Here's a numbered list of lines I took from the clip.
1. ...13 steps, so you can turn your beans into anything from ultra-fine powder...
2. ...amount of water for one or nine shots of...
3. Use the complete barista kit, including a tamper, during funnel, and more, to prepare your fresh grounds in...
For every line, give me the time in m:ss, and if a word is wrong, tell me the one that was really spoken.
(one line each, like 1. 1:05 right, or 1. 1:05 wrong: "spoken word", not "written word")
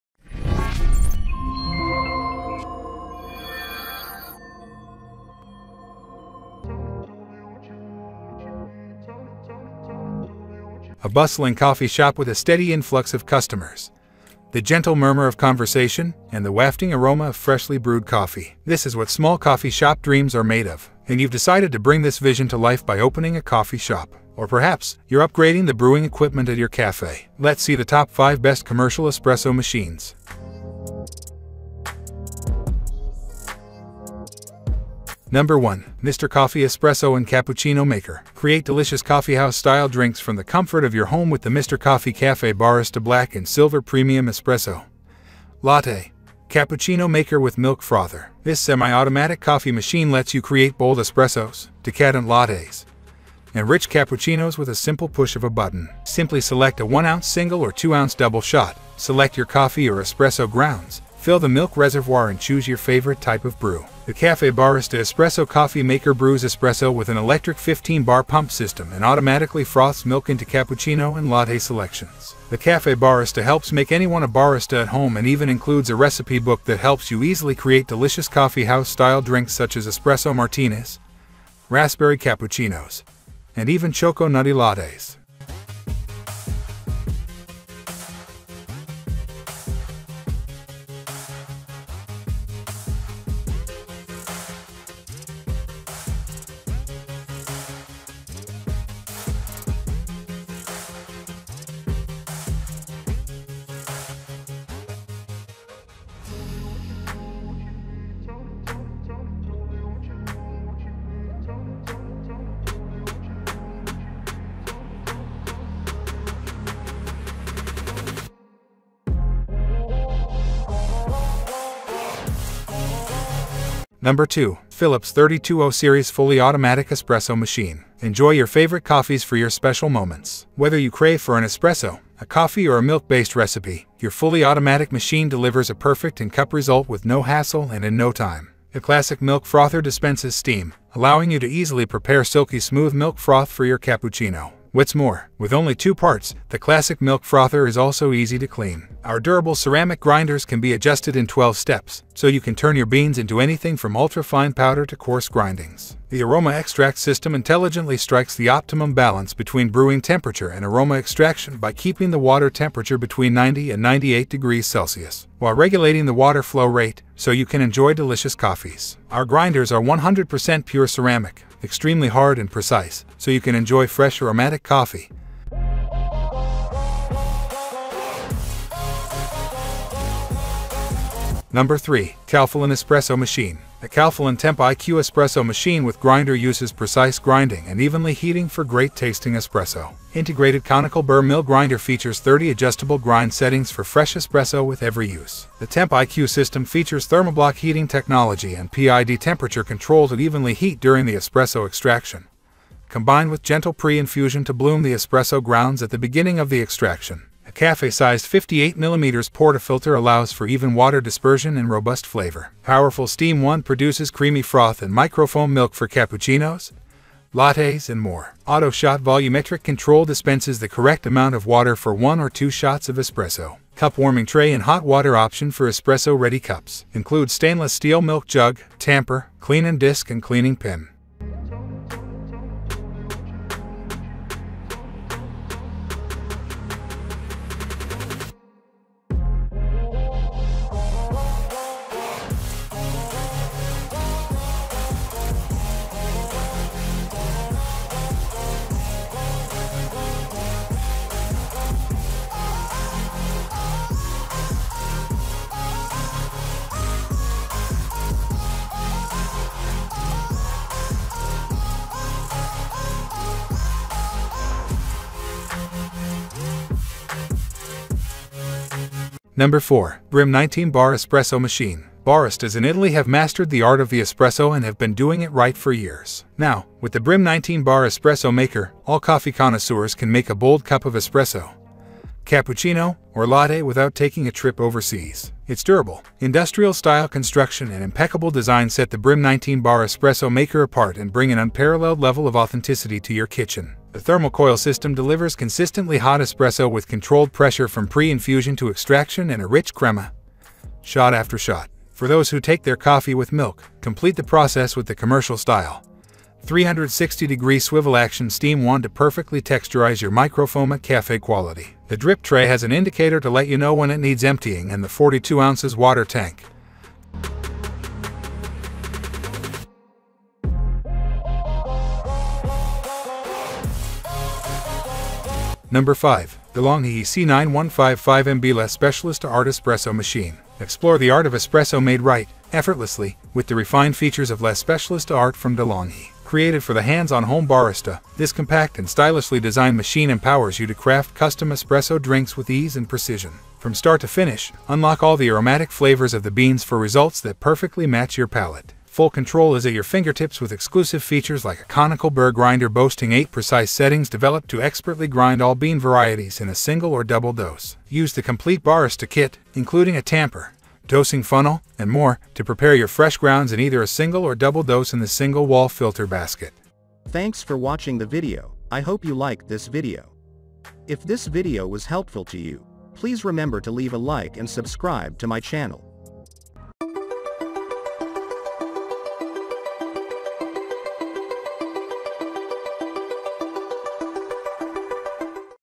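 1. 2:31 wrong: "12", not "13"
2. 3:41 wrong: "two", not "nine"
3. 5:57 wrong: "dosing", not "during".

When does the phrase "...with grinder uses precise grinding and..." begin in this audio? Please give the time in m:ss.
3:05.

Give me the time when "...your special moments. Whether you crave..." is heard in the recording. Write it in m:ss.
2:09.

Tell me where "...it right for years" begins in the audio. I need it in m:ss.
4:35.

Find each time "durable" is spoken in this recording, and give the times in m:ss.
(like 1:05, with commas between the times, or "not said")
2:29, 4:45.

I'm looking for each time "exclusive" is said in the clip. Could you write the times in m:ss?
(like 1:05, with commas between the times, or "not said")
5:50.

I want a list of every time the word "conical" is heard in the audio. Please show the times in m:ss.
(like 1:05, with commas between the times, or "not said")
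3:10, 5:51.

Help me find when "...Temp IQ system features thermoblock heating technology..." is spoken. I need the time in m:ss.
3:15.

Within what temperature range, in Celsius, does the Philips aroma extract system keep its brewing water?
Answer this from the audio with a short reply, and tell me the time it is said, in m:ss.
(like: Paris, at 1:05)
90 to 98 degrees, at 2:43.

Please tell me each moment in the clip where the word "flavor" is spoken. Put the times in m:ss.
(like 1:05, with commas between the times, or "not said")
3:32, 5:45.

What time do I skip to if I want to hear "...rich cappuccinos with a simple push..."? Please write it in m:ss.
0:53.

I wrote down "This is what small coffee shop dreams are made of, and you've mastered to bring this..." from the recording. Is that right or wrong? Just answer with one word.
wrong.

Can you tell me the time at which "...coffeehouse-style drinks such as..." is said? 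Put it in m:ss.
1:18.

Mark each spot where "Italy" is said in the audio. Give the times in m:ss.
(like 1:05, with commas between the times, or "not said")
4:32.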